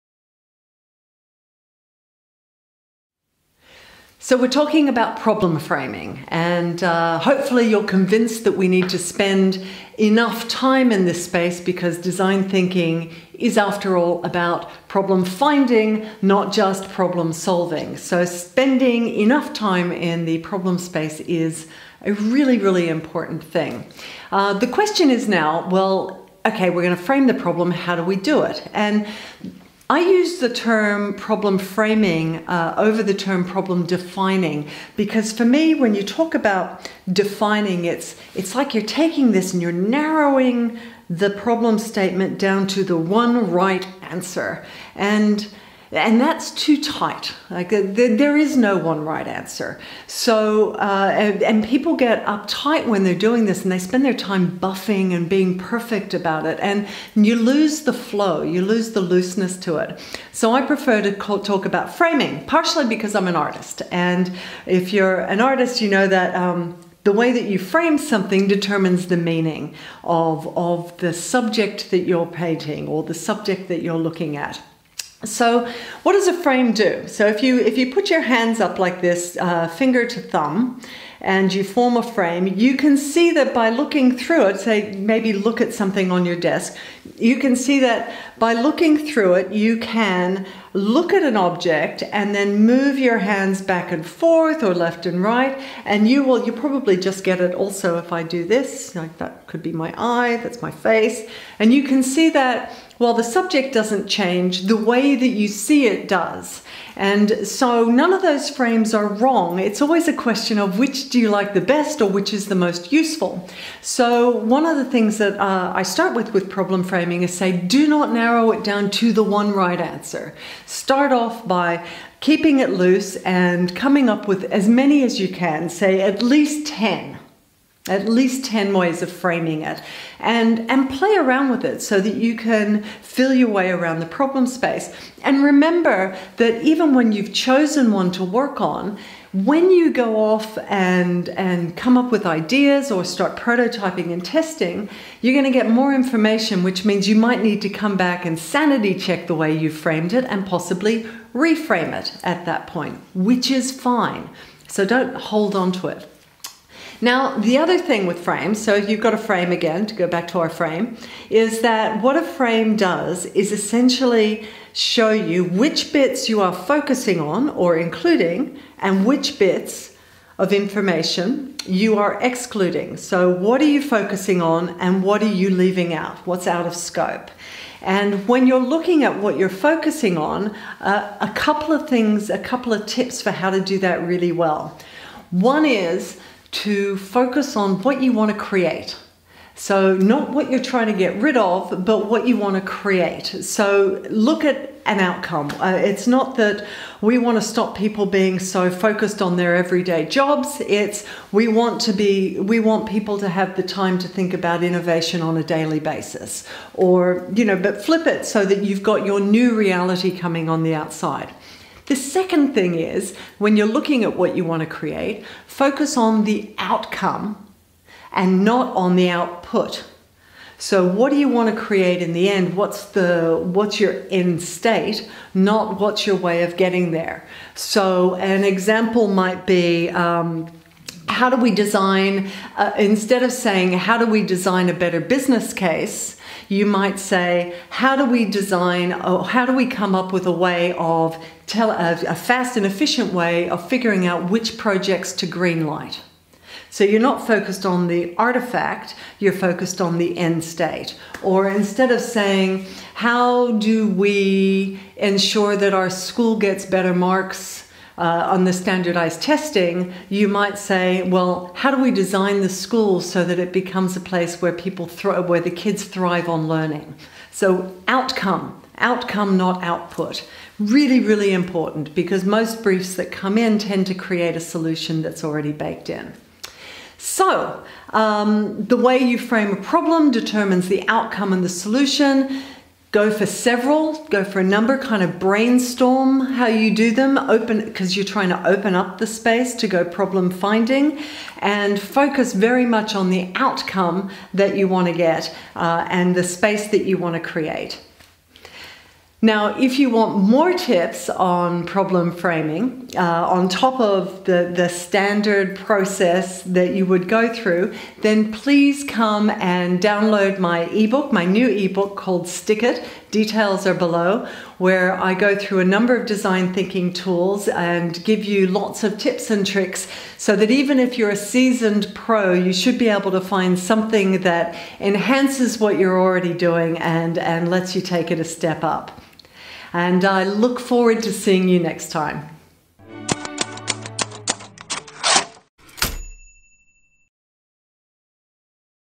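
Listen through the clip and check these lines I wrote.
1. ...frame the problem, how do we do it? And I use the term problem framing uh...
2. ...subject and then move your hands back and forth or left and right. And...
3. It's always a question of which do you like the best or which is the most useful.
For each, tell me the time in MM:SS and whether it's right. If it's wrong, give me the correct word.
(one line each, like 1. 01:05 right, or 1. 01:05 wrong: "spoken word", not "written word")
1. 00:27 right
2. 01:31 wrong: "object", not "subject"
3. 01:49 right.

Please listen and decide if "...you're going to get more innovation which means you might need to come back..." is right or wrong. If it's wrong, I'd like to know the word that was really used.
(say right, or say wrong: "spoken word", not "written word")
wrong: "information", not "innovation".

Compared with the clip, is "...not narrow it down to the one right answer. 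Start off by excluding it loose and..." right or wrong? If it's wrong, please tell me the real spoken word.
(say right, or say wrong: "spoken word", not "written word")
wrong: "keeping", not "excluding".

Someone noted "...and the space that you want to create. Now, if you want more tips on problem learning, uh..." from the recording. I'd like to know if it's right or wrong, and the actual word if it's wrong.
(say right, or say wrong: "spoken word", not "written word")
wrong: "framing", not "learning".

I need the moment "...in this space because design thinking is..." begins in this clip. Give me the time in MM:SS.
00:10.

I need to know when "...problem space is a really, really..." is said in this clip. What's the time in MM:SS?
00:20.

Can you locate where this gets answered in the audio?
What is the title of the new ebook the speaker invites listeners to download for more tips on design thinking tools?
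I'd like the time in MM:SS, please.
05:12.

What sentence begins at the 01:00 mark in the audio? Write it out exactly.
So I prefer to talk about framing, partially because I'm an artist, and if you're an artist, you know that.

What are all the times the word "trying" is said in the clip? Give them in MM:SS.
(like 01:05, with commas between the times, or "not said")
03:10, 04:48.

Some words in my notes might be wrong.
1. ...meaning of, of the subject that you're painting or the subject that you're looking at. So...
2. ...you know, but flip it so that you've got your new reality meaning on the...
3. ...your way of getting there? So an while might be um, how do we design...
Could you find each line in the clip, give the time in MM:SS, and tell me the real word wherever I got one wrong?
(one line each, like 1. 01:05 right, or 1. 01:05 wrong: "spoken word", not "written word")
1. 01:09 right
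2. 03:27 wrong: "coming", not "meaning"
3. 03:46 wrong: "example", not "while".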